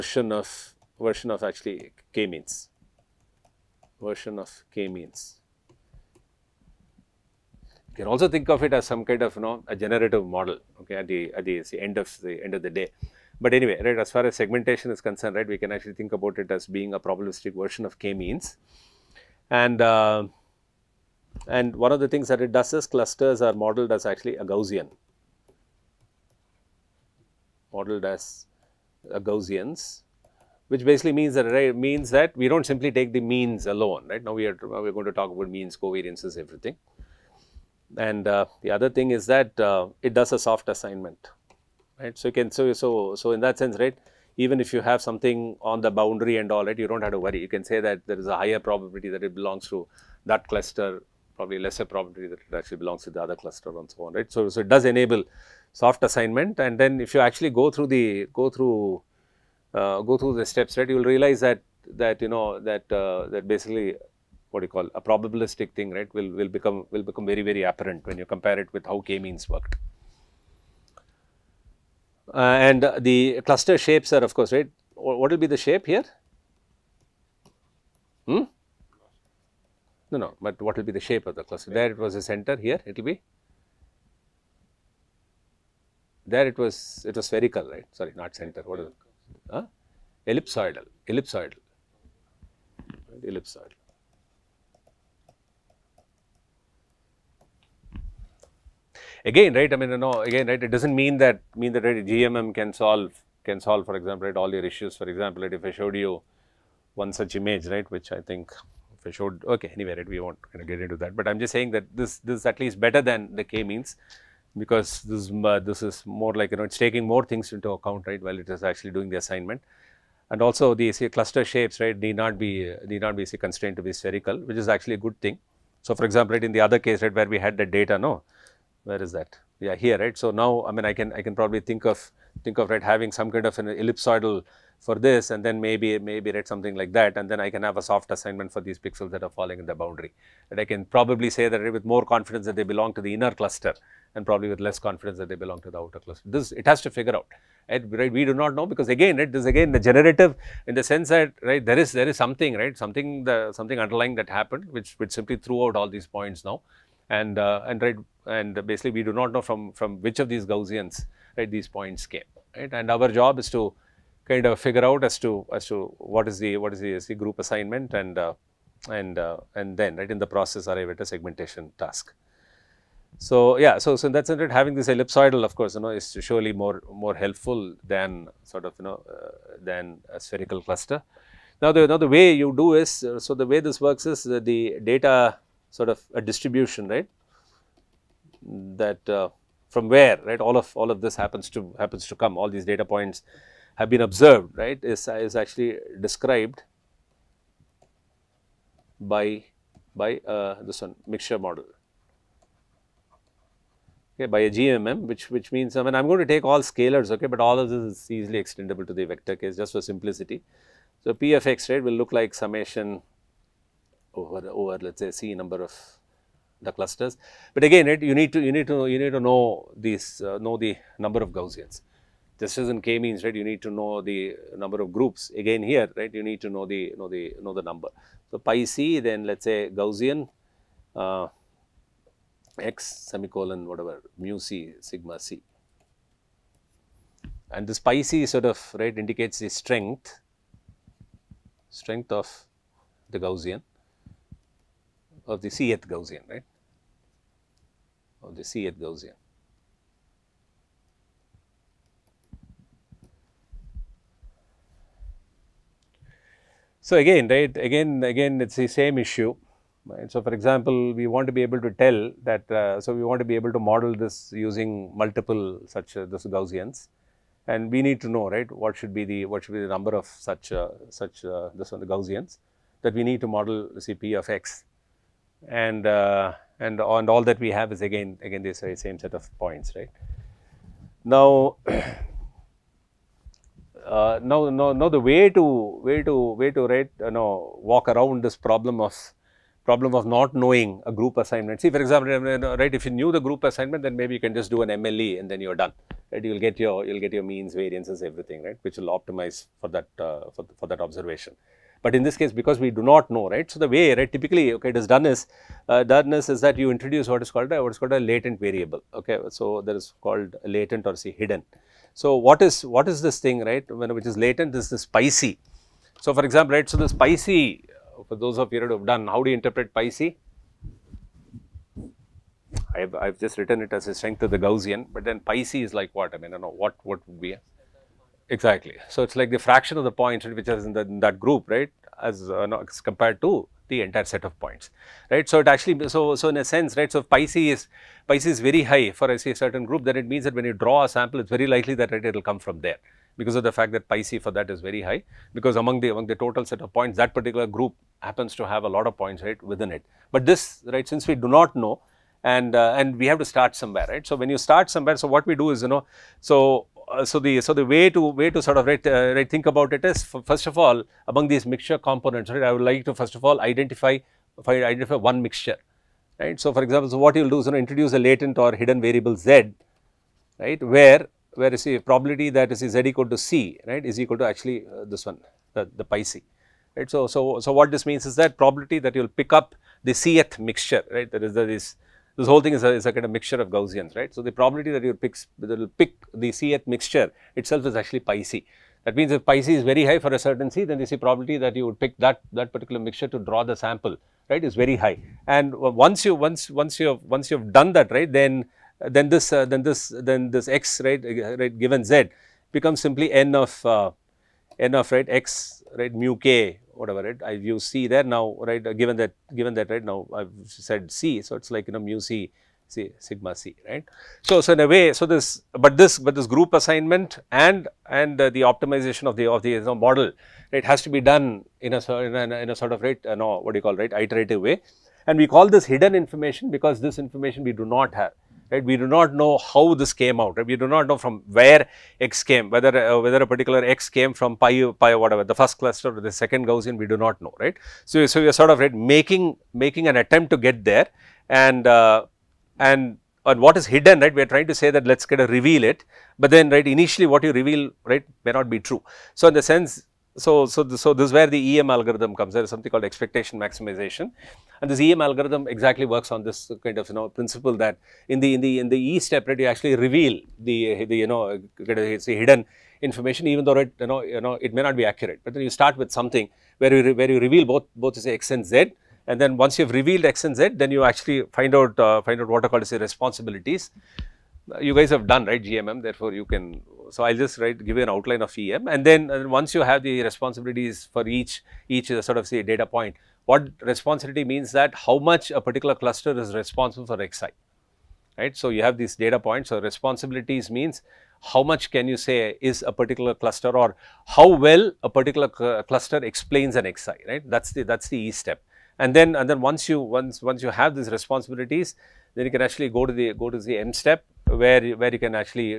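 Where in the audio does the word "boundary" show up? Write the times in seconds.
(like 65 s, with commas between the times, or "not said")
45 s, 139 s.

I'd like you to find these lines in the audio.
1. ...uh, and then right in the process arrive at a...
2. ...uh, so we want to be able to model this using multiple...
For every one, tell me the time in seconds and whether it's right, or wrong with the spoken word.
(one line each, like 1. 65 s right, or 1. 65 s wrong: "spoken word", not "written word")
1. 169 s right
2. 262 s right.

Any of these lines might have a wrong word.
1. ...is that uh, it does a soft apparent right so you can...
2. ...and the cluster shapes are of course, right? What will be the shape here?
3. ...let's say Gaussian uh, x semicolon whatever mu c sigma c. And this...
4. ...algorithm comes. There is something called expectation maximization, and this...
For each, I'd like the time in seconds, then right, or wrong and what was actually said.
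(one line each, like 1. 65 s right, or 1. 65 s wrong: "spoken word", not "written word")
1. 39 s wrong: "assignment", not "apparent"
2. 72 s right
3. 229 s right
4. 451 s right.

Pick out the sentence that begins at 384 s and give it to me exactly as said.
So, the probability that you pick, that will pick the C-th mixture itself is actually pi C.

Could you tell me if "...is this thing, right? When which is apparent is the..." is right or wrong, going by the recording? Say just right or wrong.
wrong.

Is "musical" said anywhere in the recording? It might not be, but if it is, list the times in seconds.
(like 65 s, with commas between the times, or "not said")
not said.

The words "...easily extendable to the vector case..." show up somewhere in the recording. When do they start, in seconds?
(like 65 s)
208 s.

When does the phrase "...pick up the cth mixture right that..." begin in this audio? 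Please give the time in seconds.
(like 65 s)
379 s.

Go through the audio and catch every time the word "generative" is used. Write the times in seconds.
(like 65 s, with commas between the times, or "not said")
9 s, 149 s.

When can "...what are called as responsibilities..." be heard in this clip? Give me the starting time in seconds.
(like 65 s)
472 s.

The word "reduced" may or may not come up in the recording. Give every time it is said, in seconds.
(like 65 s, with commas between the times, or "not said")
not said.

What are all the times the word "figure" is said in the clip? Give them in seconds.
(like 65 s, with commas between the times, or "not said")
146 s, 164 s.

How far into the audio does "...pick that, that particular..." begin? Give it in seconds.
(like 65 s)
391 s.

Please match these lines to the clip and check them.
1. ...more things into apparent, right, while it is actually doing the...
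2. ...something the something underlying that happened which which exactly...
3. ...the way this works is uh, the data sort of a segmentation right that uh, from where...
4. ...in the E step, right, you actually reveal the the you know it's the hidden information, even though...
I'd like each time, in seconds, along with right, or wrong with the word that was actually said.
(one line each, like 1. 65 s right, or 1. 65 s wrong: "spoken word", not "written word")
1. 117 s wrong: "account", not "apparent"
2. 152 s wrong: "simply", not "exactly"
3. 183 s wrong: "distribution", not "segmentation"
4. 458 s right.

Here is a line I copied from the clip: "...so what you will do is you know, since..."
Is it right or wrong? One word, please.
wrong.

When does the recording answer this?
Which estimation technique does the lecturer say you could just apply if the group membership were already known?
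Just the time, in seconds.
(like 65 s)
294 s.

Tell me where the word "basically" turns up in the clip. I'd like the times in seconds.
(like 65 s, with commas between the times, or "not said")
30 s, 63 s, 158 s.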